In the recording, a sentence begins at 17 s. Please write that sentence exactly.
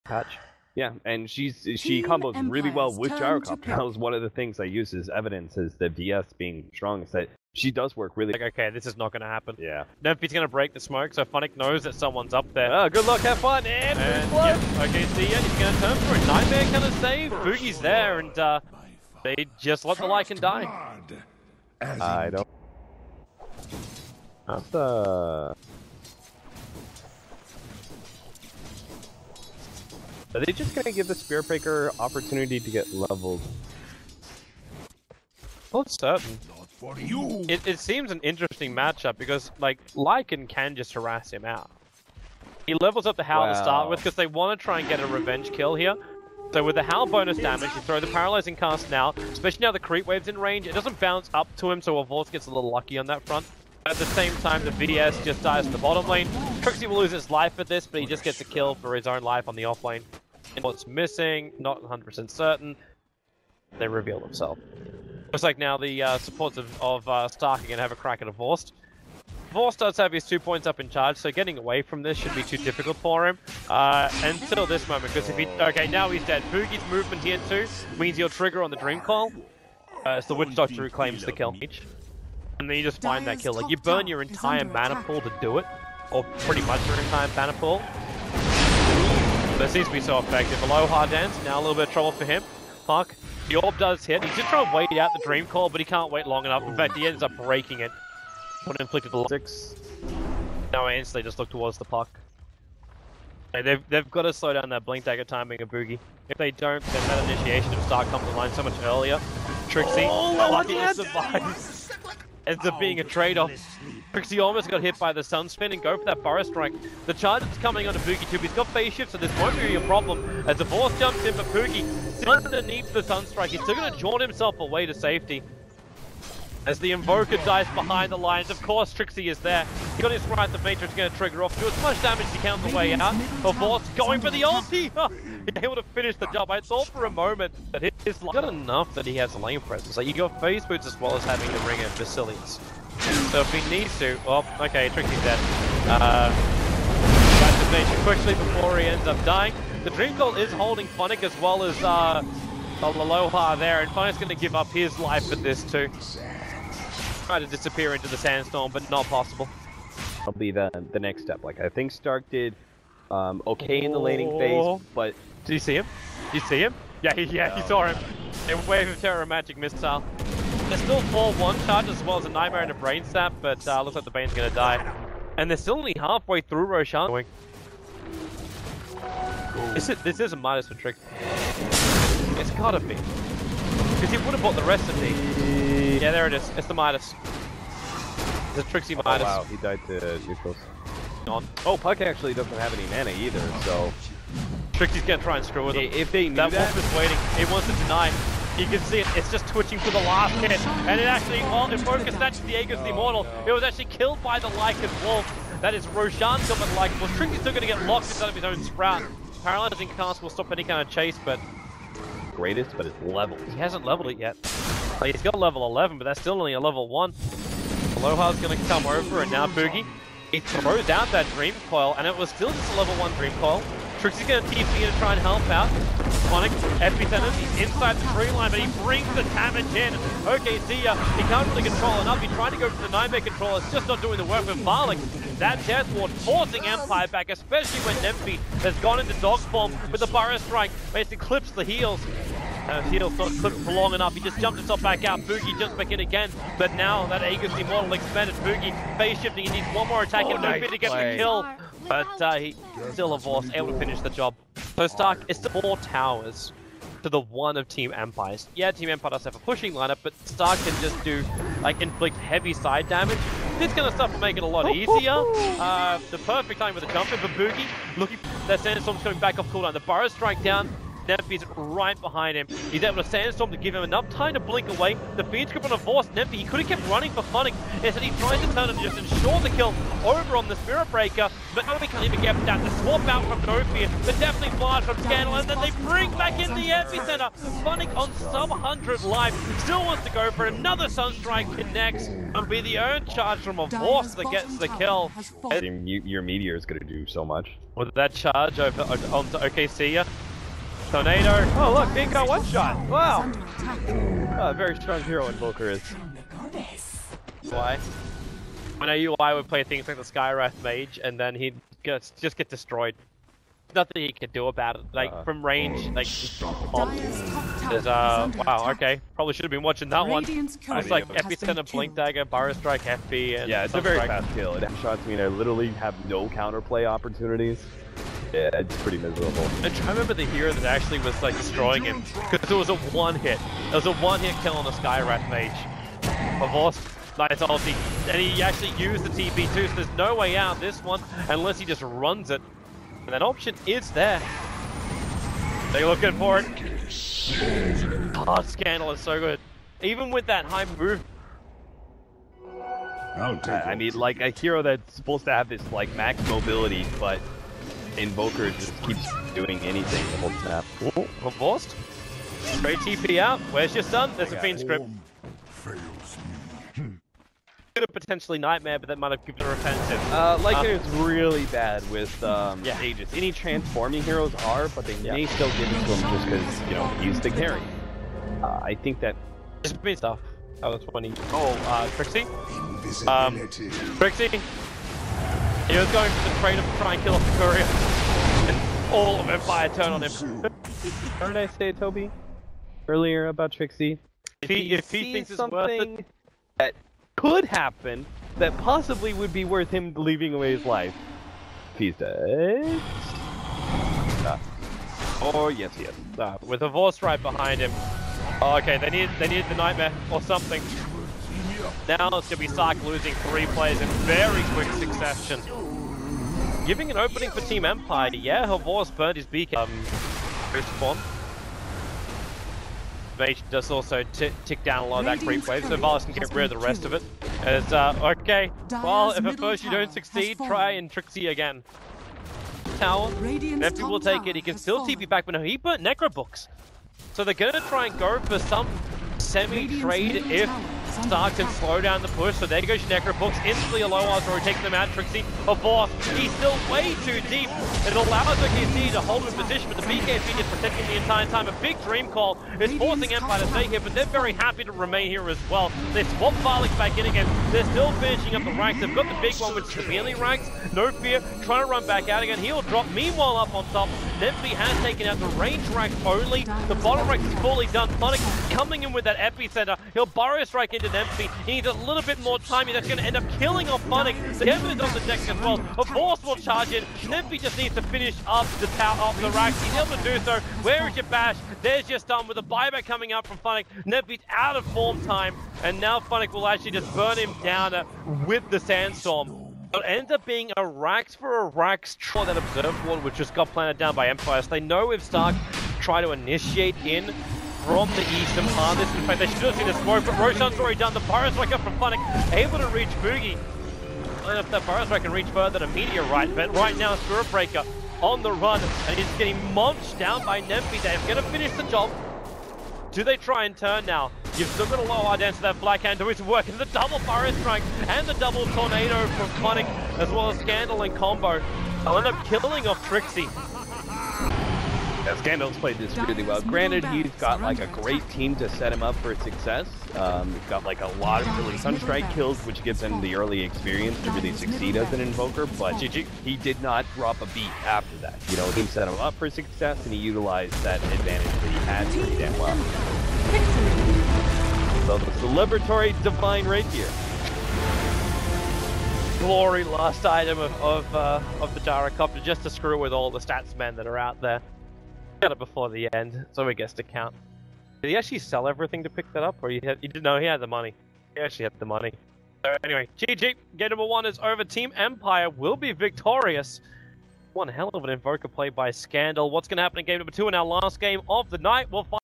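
Boogie's there, and uh, they just let the like and die.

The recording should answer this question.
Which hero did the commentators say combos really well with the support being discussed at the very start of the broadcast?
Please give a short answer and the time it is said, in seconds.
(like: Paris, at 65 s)
Gyrocopter, at 3 s.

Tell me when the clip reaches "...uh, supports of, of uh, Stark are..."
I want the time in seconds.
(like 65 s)
66 s.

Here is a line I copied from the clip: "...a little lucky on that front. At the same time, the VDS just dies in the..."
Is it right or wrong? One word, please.
right.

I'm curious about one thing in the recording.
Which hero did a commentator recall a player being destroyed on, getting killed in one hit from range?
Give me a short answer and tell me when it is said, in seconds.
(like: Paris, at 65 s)
Skywrath Mage, at 310 s.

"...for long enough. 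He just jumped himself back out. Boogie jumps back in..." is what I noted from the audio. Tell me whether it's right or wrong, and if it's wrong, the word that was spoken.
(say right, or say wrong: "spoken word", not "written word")
right.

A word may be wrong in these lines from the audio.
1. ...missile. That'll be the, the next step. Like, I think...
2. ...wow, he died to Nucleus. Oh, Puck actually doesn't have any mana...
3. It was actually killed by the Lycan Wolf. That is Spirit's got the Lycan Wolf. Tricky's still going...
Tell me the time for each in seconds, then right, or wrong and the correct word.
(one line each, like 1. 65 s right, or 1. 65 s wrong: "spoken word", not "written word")
1. 159 s wrong: "possible", not "missile"
2. 189 s right
3. 203 s wrong: "Roshan", not "Spirit".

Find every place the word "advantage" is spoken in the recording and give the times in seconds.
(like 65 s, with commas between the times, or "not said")
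540 s.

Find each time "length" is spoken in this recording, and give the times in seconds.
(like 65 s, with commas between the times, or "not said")
not said.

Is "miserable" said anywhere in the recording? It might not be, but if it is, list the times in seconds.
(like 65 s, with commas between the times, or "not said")
328 s.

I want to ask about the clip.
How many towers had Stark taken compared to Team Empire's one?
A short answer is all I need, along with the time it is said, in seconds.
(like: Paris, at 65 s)
4, at 255 s.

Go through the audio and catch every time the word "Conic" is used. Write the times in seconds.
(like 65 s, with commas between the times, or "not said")
519 s.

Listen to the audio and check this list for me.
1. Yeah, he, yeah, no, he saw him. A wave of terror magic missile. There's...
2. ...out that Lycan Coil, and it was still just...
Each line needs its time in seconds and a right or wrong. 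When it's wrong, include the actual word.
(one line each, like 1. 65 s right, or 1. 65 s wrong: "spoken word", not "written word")
1. 167 s right
2. 220 s wrong: "Dream", not "Lycan".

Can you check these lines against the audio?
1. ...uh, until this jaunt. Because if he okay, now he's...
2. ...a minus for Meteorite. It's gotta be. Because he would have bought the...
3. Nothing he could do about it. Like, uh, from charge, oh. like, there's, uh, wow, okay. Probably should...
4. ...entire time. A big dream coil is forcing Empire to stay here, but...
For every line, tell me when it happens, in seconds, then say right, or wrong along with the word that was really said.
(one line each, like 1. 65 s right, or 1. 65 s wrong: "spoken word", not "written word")
1. 73 s wrong: "moment", not "jaunt"
2. 180 s wrong: "Trick", not "Meteorite"
3. 313 s wrong: "range", not "charge"
4. 450 s right.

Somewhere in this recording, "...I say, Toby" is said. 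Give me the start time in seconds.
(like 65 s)
391 s.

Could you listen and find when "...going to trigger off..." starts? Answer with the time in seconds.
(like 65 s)
130 s.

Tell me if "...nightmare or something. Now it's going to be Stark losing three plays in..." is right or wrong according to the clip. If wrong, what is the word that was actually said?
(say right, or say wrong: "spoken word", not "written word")
right.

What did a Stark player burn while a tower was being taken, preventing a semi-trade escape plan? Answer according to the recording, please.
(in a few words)
Necro Books.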